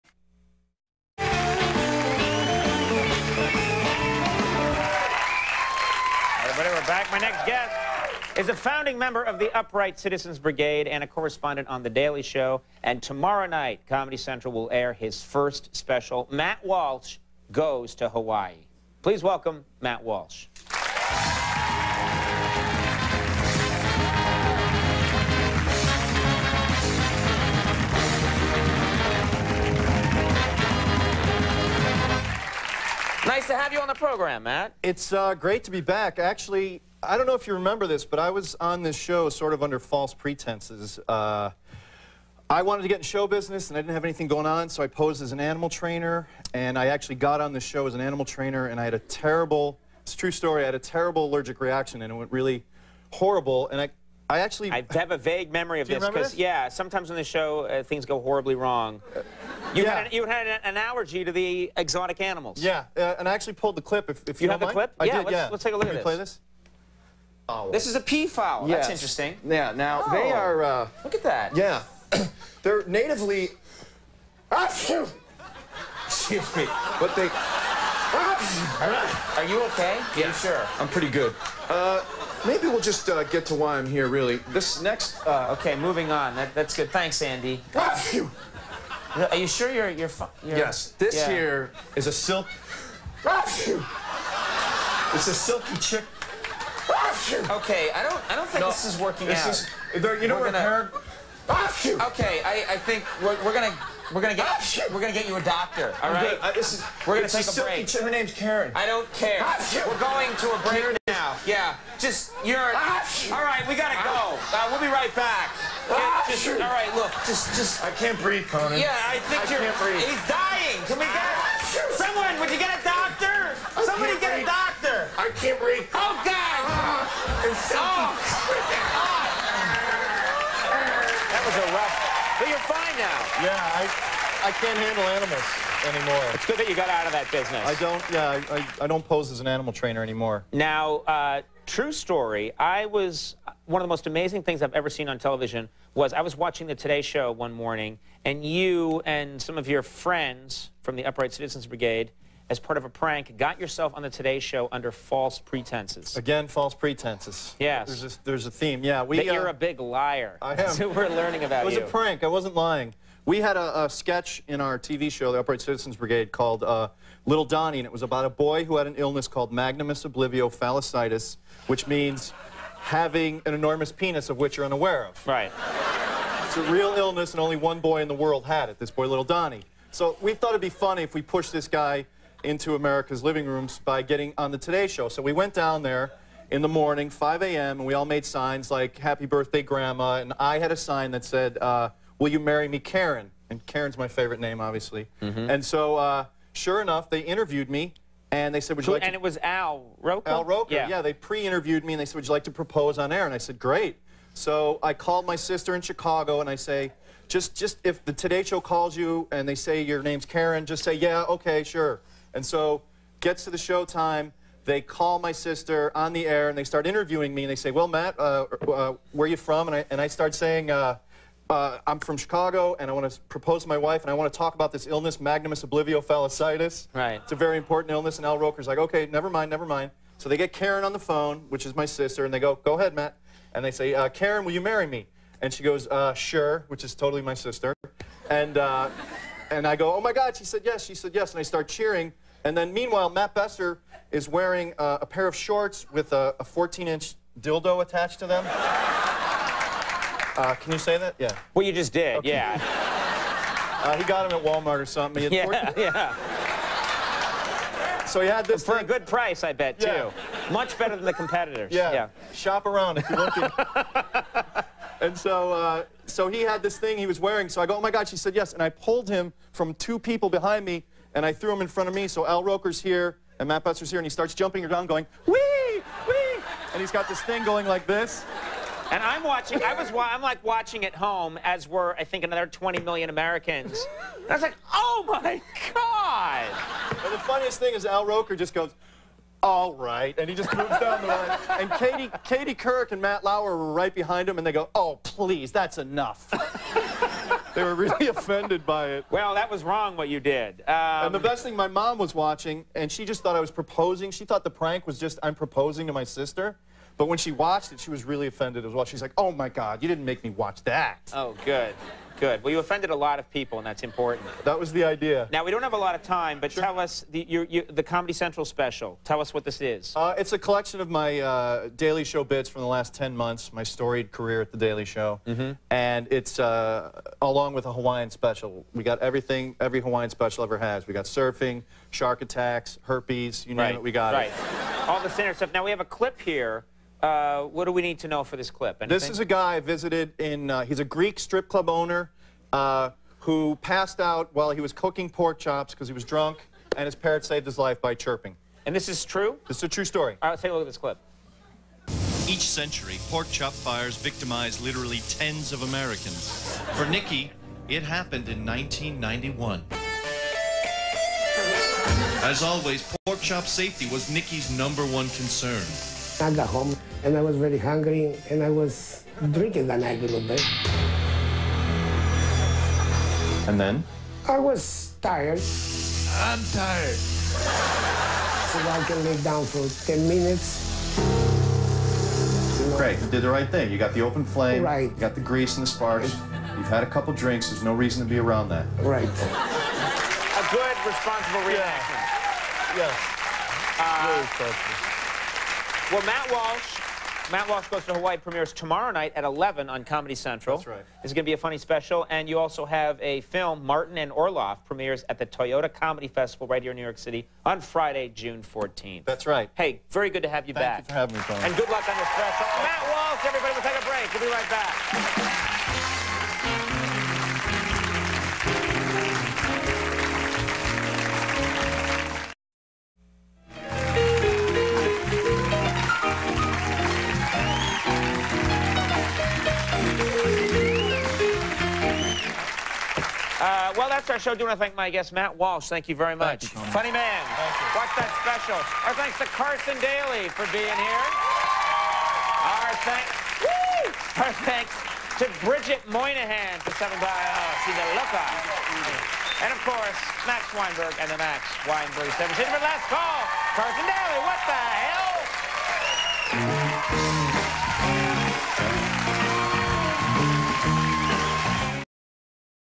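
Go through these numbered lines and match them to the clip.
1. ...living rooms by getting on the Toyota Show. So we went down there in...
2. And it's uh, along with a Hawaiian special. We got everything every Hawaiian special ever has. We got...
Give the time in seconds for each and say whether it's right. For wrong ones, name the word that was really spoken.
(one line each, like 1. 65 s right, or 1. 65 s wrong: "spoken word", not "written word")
1. 183 s wrong: "Today", not "Toyota"
2. 325 s right.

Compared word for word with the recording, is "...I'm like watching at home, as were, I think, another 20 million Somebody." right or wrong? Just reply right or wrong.
wrong.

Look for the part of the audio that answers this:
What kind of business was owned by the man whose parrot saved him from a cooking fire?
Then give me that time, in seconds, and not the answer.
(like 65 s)
341 s.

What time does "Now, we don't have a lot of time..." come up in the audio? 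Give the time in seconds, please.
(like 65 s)
315 s.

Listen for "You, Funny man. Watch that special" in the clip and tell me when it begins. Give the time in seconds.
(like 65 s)
436 s.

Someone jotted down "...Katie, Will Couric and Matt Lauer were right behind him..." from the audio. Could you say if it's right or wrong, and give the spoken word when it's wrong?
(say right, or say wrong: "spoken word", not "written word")
wrong: "Katie", not "Will".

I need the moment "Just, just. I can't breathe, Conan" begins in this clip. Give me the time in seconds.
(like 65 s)
117 s.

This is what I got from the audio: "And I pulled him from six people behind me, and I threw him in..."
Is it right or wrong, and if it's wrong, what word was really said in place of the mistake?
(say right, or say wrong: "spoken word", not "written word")
wrong: "two", not "six".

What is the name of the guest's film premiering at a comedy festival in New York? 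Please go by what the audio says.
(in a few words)
Martin and Orloff.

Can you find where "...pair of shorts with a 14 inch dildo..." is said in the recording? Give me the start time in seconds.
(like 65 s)
245 s.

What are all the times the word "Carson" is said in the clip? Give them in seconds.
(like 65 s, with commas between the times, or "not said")
439 s, 453 s.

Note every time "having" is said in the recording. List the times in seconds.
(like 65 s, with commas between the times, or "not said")
172 s, 411 s.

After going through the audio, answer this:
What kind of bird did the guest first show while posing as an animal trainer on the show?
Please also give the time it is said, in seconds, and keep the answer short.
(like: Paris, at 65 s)
peafowl, at 68 s.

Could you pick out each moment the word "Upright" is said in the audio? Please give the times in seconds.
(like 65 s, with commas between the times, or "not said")
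9 s, 151 s, 165 s.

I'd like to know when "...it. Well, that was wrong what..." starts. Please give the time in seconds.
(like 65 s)
298 s.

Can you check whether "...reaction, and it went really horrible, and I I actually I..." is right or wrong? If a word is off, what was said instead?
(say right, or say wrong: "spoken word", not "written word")
right.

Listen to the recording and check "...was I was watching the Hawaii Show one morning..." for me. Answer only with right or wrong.
wrong.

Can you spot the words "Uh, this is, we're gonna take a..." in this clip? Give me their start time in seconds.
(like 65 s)
106 s.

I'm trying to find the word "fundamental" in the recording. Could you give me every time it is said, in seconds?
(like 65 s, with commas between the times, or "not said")
not said.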